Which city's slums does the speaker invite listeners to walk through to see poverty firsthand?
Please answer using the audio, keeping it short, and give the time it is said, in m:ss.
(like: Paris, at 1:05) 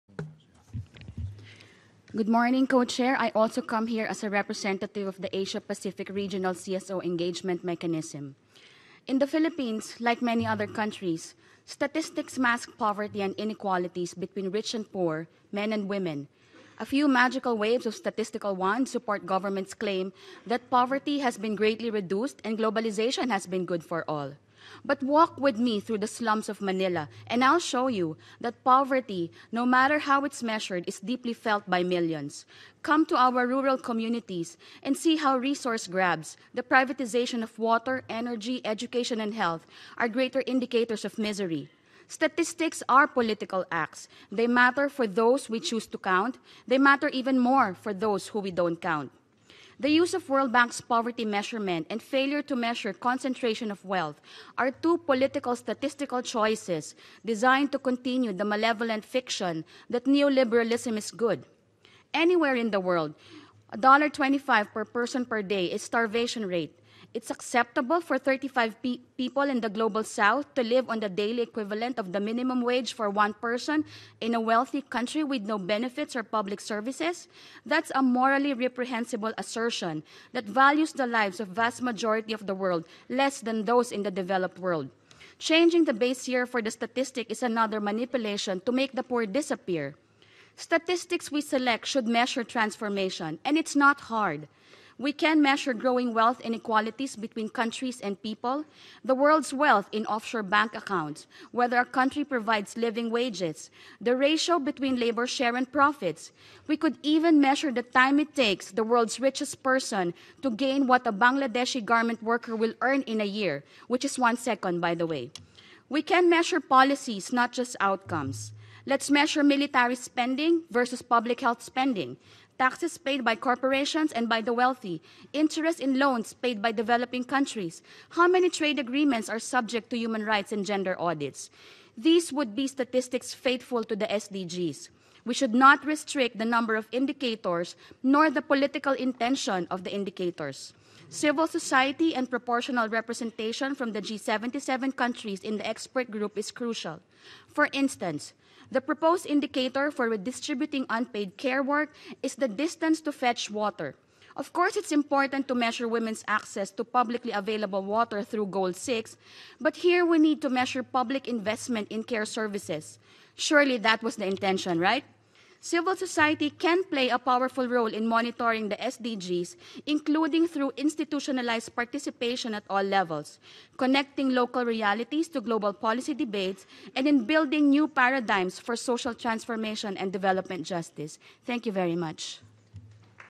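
Manila, at 0:26.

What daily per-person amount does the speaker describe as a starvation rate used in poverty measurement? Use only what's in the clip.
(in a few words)
$1.25.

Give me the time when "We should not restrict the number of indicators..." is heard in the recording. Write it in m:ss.
2:15.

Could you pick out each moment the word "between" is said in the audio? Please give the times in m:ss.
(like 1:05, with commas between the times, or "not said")
0:14, 1:37, 1:44.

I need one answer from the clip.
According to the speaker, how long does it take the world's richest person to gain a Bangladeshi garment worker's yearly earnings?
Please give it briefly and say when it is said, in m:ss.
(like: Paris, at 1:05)
1 second, at 1:54.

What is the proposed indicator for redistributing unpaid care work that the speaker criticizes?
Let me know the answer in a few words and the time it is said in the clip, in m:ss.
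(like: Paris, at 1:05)
Distance to fetch water, at 2:32.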